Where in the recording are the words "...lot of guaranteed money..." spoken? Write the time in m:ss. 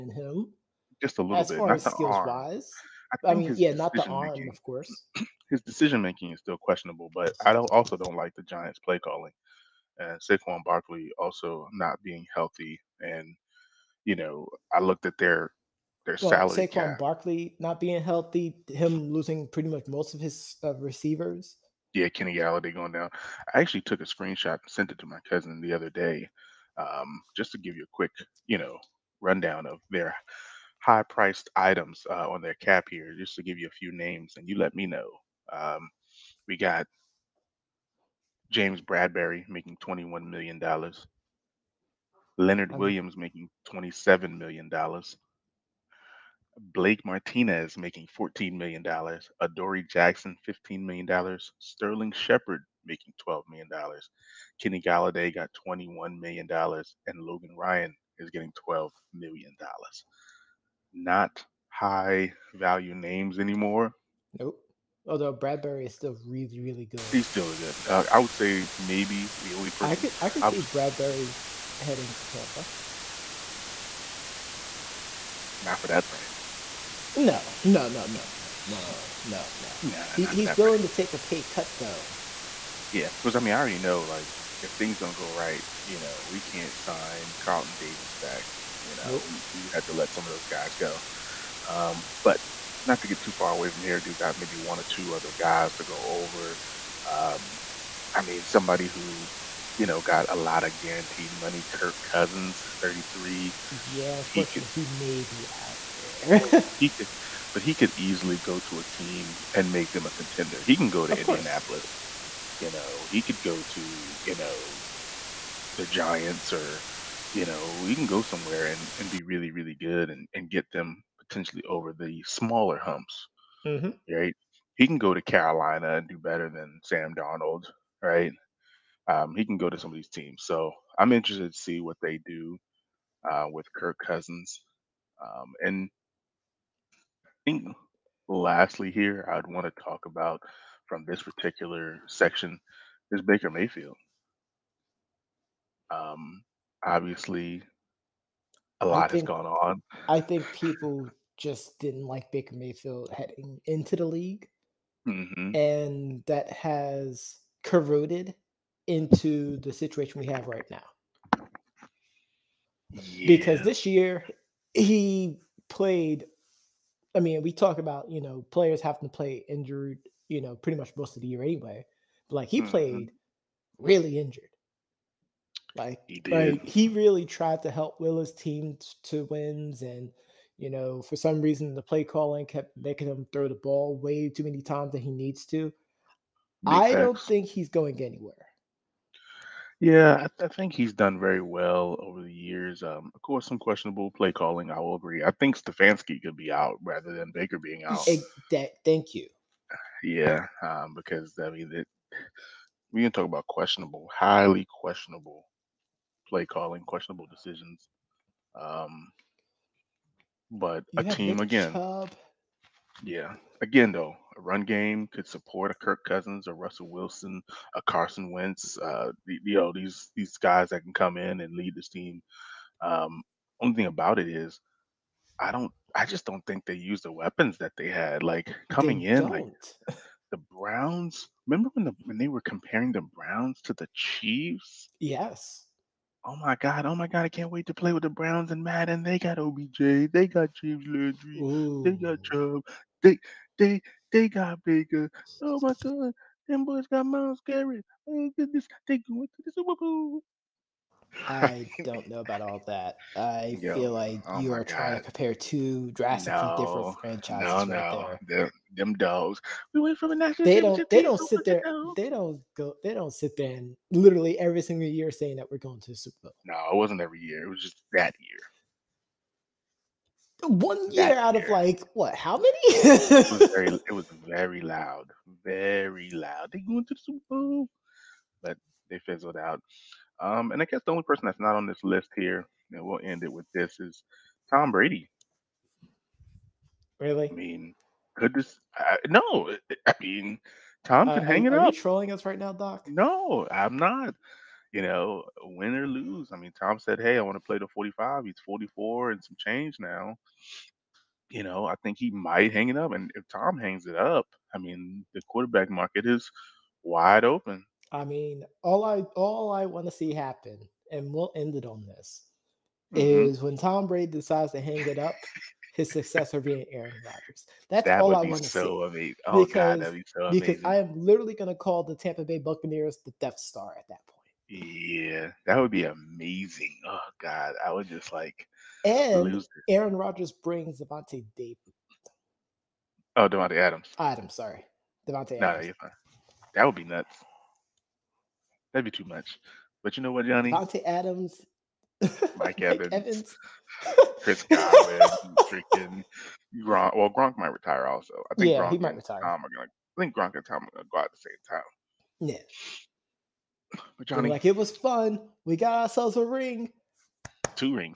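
1:40.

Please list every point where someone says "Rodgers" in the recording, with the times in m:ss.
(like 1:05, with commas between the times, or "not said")
5:17, 5:29.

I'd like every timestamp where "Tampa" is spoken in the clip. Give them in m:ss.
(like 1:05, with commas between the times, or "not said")
1:12, 5:21.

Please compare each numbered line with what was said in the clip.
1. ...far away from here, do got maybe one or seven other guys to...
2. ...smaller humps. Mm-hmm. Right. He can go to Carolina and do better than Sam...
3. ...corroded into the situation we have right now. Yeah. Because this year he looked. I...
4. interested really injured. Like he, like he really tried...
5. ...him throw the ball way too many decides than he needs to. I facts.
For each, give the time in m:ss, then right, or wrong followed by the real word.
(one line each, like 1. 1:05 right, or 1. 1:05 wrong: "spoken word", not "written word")
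1. 1:33 wrong: "two", not "seven"
2. 2:02 right
3. 2:37 wrong: "played", not "looked"
4. 2:52 wrong: "played", not "interested"
5. 3:03 wrong: "times", not "decides".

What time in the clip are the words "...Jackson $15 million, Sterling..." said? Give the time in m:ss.
0:49.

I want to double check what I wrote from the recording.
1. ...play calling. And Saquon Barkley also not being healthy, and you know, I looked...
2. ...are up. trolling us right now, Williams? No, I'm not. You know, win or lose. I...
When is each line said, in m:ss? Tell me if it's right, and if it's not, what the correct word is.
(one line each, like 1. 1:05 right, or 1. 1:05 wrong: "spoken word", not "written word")
1. 0:08 right
2. 4:51 wrong: "Doc", not "Williams".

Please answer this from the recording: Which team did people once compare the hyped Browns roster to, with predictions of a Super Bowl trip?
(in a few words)
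the Chiefs.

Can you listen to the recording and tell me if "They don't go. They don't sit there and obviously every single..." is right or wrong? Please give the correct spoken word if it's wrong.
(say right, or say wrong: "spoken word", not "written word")
wrong: "literally", not "obviously".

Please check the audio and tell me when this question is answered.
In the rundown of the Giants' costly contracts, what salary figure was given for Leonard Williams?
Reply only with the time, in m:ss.
0:43.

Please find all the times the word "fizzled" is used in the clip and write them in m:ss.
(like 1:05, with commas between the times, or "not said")
4:38.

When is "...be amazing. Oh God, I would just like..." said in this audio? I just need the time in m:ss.
5:25.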